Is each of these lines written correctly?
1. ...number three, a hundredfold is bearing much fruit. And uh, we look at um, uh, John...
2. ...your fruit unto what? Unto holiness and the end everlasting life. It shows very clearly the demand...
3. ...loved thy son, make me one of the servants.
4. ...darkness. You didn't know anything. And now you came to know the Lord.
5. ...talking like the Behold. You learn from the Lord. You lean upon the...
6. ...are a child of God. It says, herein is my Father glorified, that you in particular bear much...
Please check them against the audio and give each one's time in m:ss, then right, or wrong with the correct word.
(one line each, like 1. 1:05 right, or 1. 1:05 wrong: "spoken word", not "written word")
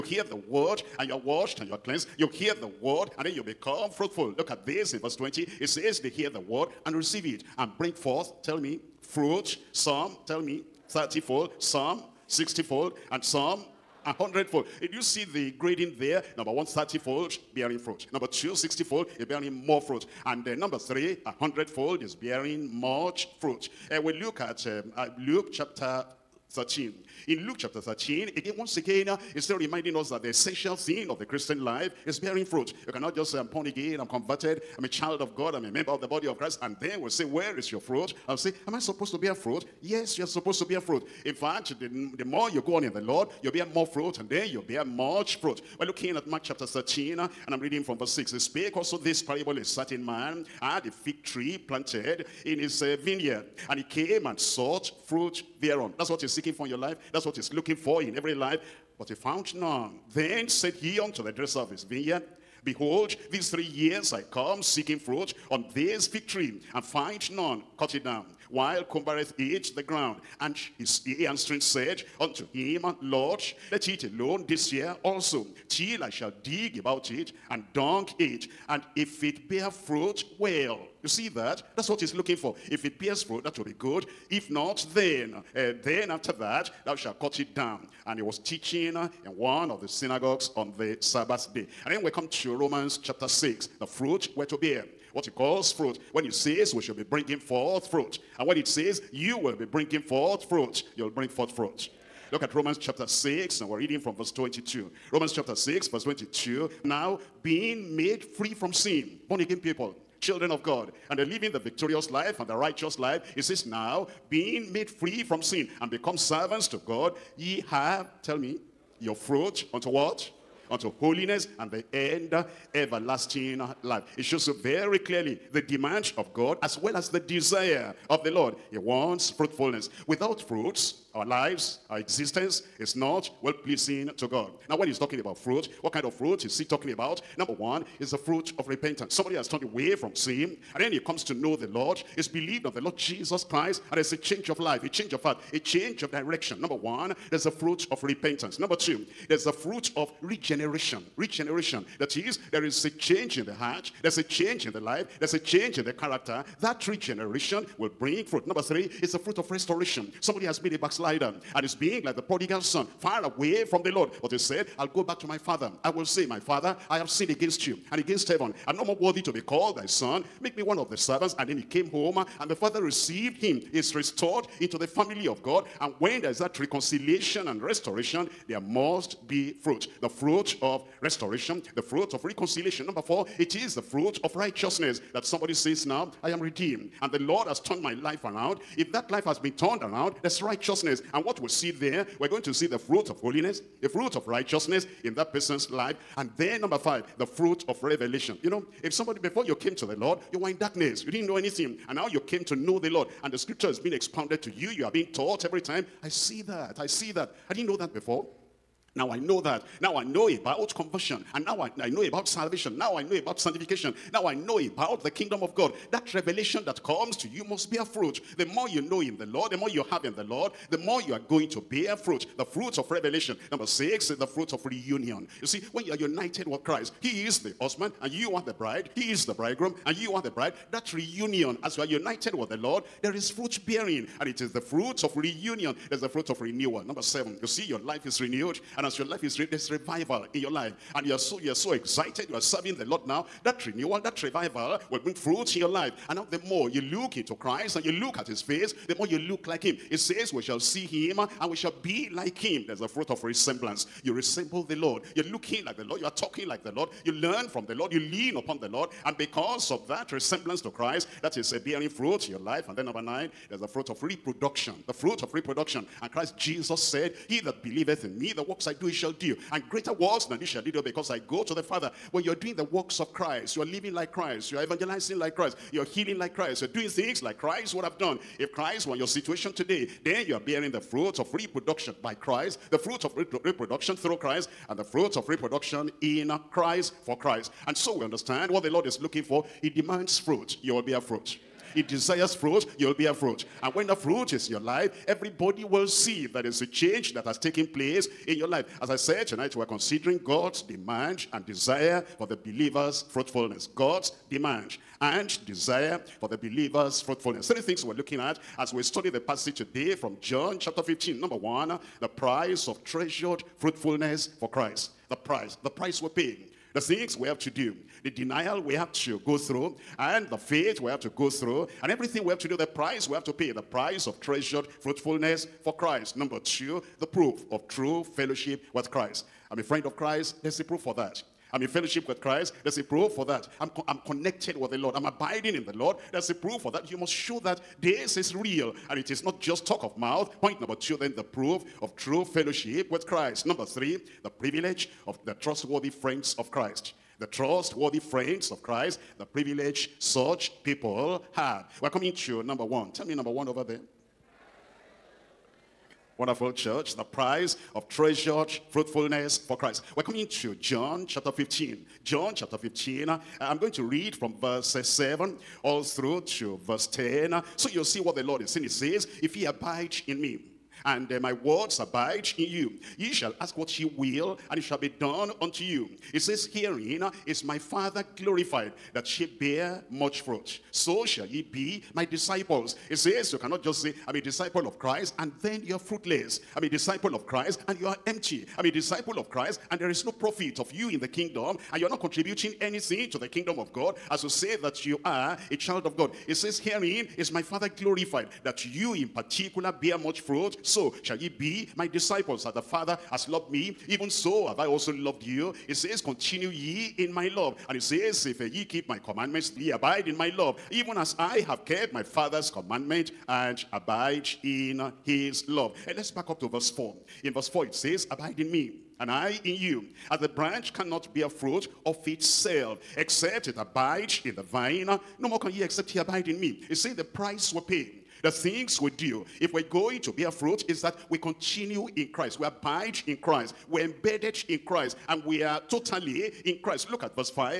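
1. 0:20 wrong: "Luke", not "John"
2. 1:58 right
3. 2:49 wrong: "called", not "loved"
4. 3:20 right
5. 4:16 wrong: "Lord", not "Behold"
6. 6:35 right.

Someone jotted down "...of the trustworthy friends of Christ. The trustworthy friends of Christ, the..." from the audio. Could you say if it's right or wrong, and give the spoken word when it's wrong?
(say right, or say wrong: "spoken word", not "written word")
right.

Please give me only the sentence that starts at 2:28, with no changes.
Number two, there's a fruit of regeneration.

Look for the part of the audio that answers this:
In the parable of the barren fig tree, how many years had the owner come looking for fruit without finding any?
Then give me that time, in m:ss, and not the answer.
1:03.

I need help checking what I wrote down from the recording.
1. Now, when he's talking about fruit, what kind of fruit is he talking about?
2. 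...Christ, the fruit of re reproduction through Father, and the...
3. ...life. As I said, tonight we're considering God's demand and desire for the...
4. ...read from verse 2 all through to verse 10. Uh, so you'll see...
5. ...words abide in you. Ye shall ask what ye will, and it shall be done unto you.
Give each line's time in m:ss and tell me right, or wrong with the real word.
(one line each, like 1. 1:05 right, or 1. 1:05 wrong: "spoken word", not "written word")
1. 2:14 right
2. 4:42 wrong: "Christ", not "Father"
3. 4:58 right
4. 6:03 wrong: "7", not "2"
5. 6:11 right.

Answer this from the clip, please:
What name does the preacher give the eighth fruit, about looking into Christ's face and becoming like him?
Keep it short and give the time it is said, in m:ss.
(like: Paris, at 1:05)
Fruit of resemblance, at 4:12.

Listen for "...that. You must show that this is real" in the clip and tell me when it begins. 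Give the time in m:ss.
5:36.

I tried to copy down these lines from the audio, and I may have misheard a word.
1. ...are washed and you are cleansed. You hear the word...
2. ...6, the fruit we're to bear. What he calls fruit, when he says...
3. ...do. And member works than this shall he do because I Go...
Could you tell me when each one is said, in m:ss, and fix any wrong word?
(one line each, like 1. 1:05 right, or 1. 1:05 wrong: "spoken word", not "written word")
1. 0:01 right
2. 1:33 right
3. 4:29 wrong: "greater", not "member".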